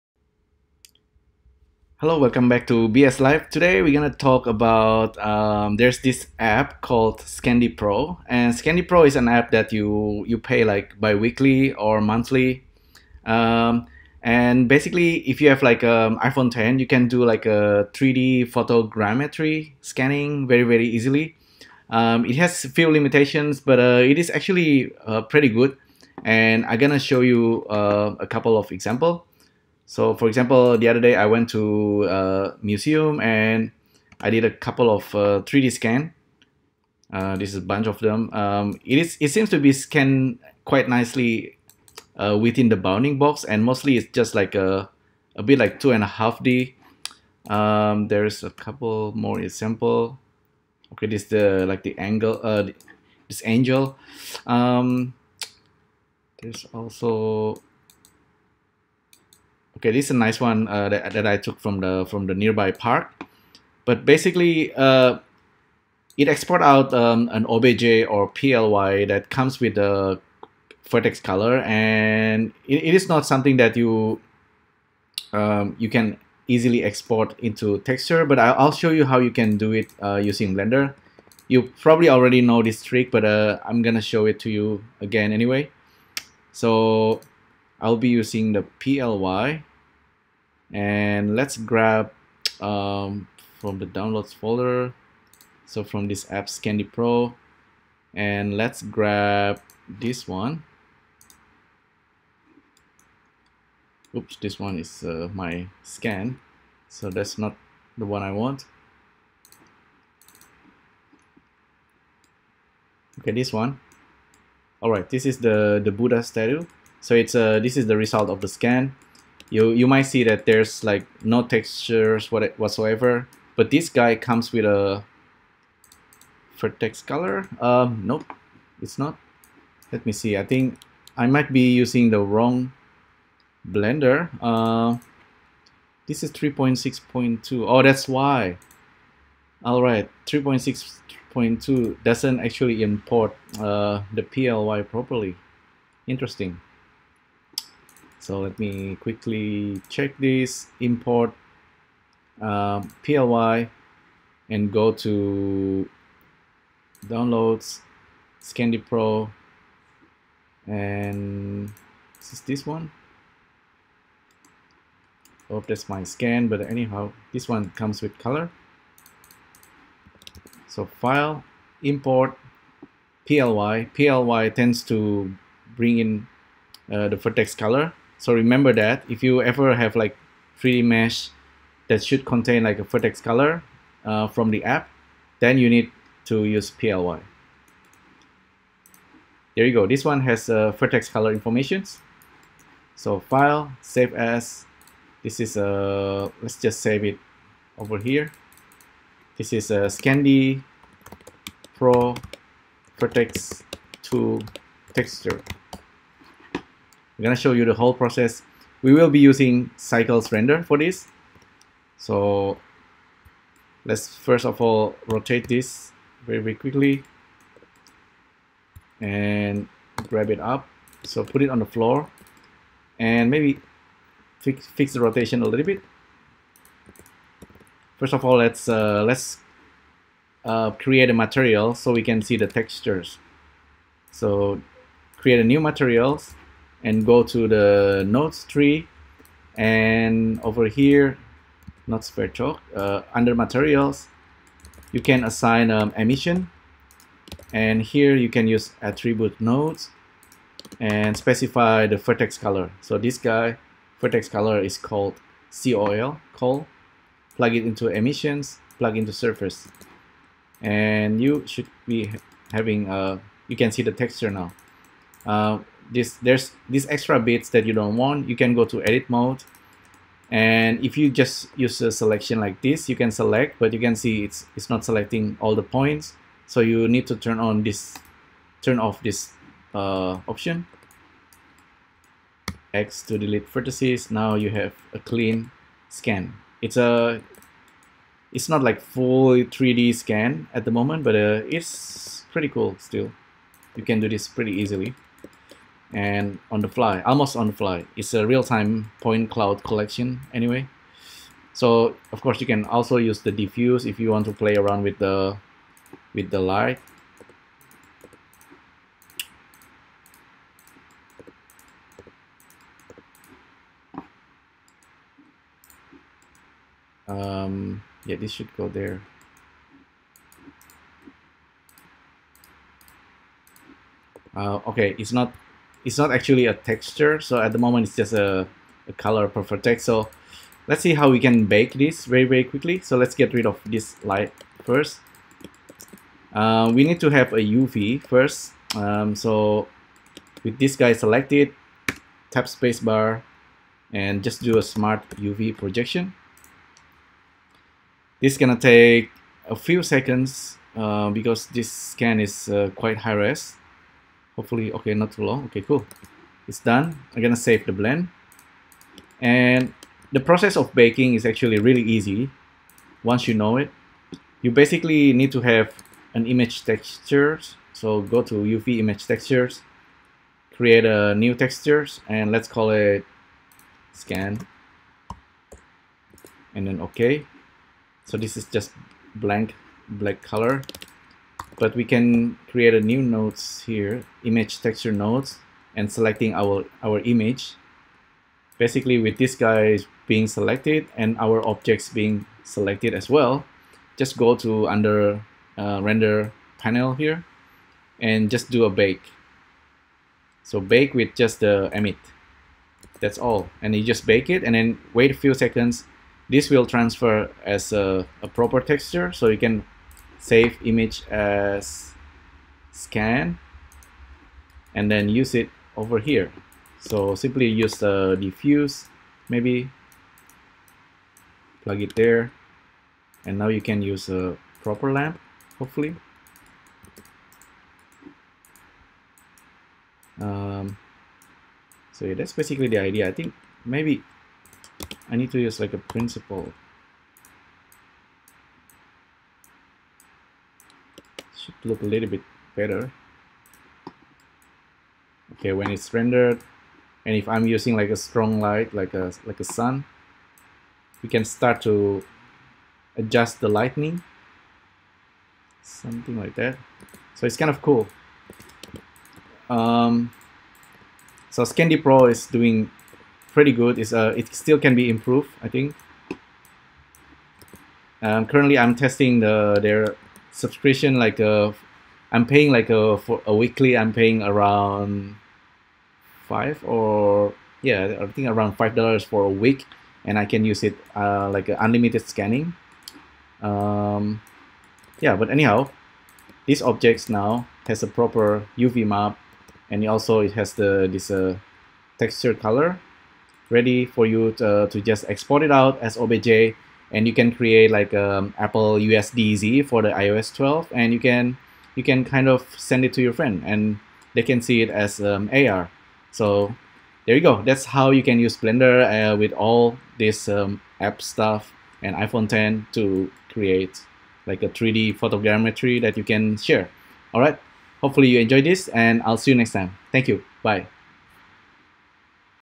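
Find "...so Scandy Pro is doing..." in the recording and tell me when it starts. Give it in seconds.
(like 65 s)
461 s.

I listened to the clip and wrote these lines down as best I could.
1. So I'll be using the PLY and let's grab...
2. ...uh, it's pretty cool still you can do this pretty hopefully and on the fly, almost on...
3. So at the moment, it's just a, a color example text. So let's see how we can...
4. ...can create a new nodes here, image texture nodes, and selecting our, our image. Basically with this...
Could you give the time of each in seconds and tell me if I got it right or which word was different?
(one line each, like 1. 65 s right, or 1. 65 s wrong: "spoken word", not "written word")
1. 86 s right
2. 291 s wrong: "easily", not "hopefully"
3. 327 s wrong: "profile", not "example"
4. 381 s right.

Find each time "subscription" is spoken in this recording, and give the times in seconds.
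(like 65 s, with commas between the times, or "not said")
470 s.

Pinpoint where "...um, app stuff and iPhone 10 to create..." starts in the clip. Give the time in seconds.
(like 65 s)
510 s.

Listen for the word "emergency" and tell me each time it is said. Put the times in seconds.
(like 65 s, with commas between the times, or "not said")
not said.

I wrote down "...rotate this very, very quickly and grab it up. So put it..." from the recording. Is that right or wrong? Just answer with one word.
right.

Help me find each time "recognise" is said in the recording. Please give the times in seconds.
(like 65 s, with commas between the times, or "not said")
not said.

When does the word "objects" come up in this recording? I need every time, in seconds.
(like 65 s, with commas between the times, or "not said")
391 s, 486 s.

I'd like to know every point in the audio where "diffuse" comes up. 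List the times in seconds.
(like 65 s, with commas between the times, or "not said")
303 s, 418 s.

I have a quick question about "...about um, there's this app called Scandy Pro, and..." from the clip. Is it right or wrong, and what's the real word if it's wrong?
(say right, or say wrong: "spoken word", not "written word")
right.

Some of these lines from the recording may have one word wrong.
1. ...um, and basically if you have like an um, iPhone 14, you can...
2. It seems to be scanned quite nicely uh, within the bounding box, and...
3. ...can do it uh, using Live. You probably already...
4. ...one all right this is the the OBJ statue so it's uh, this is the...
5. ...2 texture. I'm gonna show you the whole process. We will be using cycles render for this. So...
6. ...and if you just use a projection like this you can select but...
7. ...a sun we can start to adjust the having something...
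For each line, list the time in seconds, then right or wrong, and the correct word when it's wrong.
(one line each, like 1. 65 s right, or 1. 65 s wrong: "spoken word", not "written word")
1. 13 s wrong: "10", not "14"
2. 39 s right
3. 79 s wrong: "Blender", not "Live"
4. 113 s wrong: "Buddha", not "OBJ"
5. 204 s right
6. 270 s wrong: "selection", not "projection"
7. 449 s wrong: "lightning", not "having".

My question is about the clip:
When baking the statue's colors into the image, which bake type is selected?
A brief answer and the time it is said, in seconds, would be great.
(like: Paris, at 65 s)
Emit, at 401 s.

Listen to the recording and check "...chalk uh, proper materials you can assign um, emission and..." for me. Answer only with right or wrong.
wrong.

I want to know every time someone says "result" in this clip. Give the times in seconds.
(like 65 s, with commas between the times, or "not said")
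117 s.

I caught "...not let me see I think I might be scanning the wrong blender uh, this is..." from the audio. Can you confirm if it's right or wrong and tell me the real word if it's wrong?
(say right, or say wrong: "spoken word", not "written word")
wrong: "using", not "scanning".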